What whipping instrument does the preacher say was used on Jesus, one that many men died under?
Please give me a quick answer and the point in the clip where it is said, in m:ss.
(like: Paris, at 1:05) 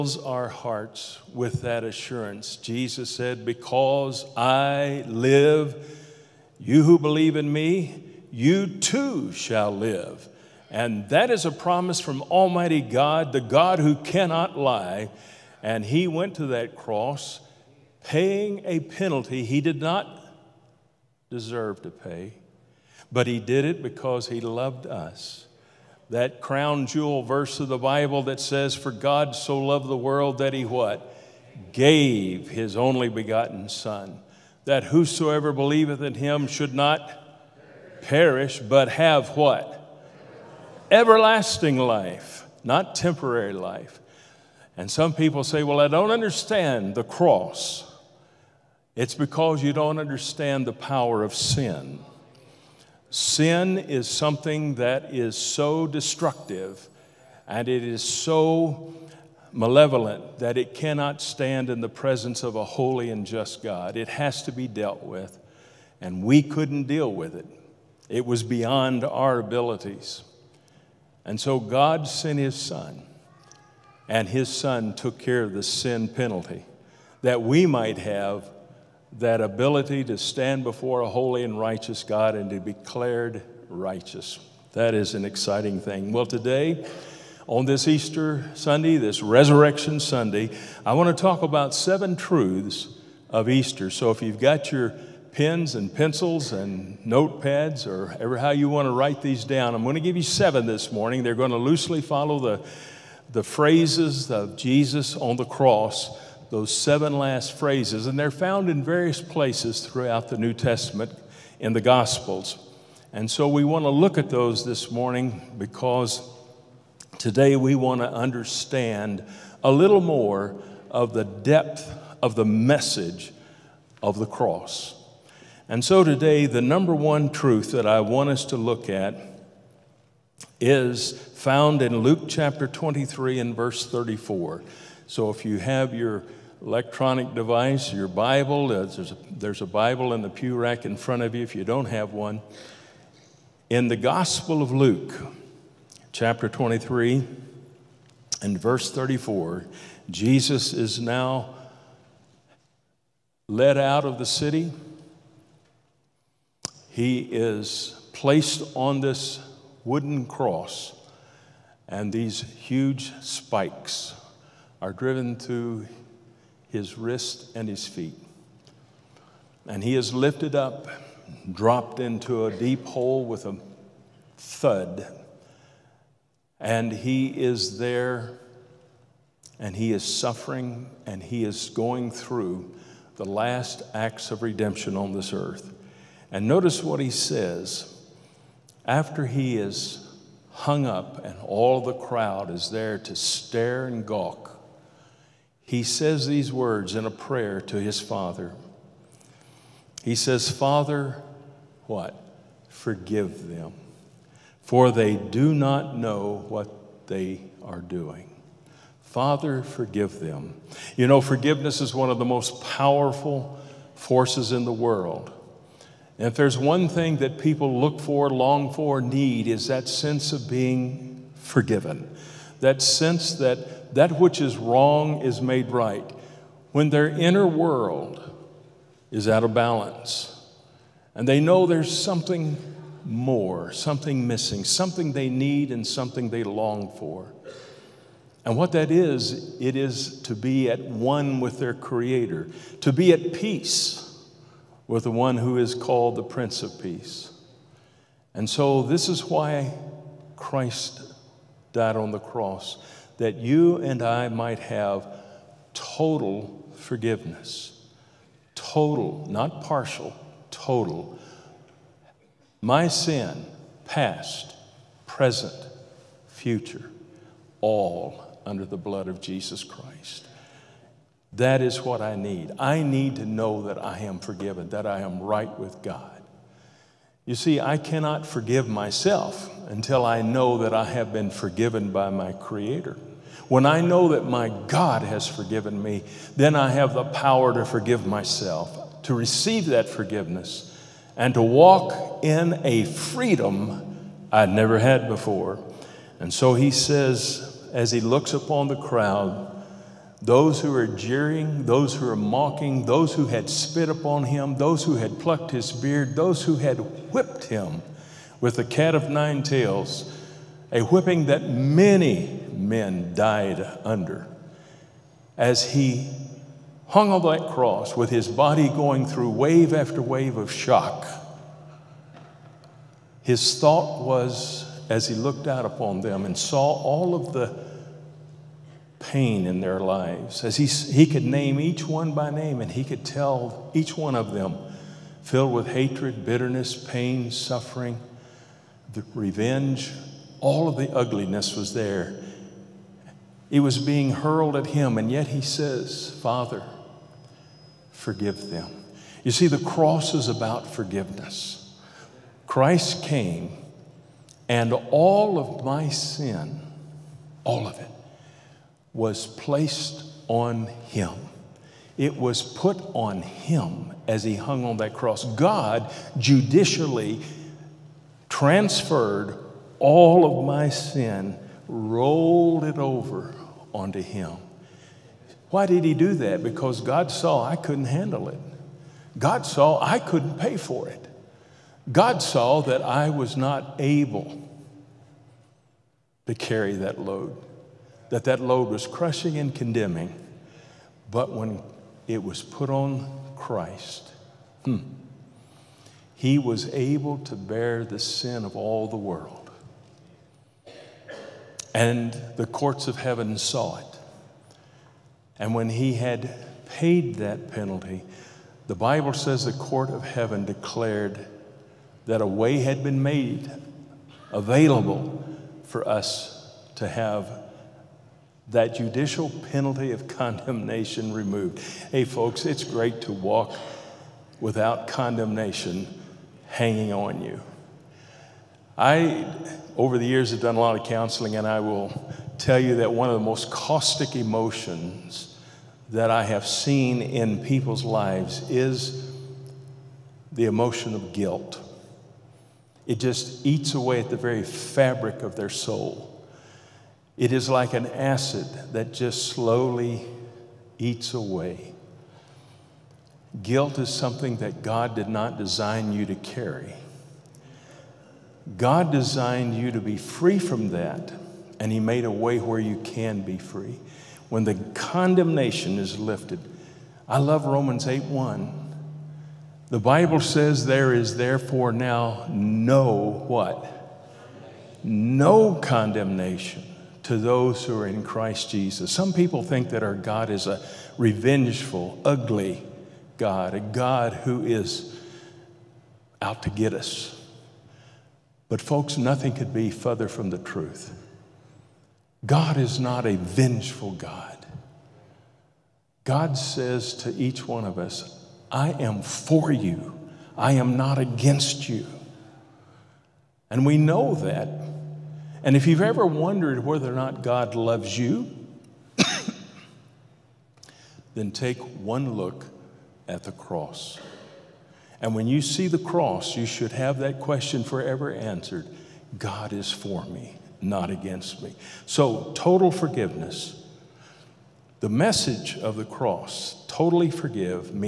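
cat of nine tails, at 5:08.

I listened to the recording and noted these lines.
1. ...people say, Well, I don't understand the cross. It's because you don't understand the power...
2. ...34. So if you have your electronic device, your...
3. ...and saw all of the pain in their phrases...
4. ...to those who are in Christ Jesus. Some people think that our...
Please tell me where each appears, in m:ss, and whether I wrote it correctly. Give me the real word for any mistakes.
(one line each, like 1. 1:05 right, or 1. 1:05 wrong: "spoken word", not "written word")
1. 0:45 right
2. 2:13 right
3. 5:26 wrong: "lives", not "phrases"
4. 7:57 right.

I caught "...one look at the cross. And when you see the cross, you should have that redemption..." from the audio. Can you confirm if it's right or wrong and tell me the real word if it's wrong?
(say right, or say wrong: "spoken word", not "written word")
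wrong: "question", not "redemption".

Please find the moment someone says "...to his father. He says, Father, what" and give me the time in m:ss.
3:17.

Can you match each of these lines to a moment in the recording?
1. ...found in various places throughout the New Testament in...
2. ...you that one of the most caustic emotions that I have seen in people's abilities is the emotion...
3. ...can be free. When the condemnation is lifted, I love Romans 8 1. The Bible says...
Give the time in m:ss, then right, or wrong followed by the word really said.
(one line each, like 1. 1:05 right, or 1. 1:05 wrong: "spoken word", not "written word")
1. 1:48 right
2. 7:12 wrong: "lives", not "abilities"
3. 7:42 right.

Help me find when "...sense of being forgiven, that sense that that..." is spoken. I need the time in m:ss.
3:39.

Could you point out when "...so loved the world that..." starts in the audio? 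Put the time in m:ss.
0:29.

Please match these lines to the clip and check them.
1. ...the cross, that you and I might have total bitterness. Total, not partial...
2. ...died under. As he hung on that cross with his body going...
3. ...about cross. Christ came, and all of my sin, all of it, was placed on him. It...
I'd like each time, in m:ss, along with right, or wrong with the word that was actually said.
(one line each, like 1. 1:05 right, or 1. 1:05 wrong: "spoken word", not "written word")
1. 4:12 wrong: "forgiveness", not "bitterness"
2. 5:13 right
3. 5:50 wrong: "forgiveness", not "cross".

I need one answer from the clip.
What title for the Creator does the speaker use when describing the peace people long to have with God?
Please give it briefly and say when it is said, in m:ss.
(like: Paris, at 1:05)
Prince of Peace, at 4:06.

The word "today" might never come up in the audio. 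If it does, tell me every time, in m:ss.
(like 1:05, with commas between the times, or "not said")
1:26, 1:57, 2:06.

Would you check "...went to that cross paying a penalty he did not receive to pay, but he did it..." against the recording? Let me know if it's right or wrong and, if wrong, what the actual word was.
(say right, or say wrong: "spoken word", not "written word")
wrong: "deserve", not "receive".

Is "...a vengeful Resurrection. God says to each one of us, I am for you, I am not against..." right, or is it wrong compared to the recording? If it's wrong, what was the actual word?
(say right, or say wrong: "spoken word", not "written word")
wrong: "God", not "Resurrection".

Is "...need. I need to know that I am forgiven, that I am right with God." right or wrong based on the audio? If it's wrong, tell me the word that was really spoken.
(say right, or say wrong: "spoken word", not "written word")
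right.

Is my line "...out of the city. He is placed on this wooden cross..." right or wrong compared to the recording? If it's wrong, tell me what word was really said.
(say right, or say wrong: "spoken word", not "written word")
right.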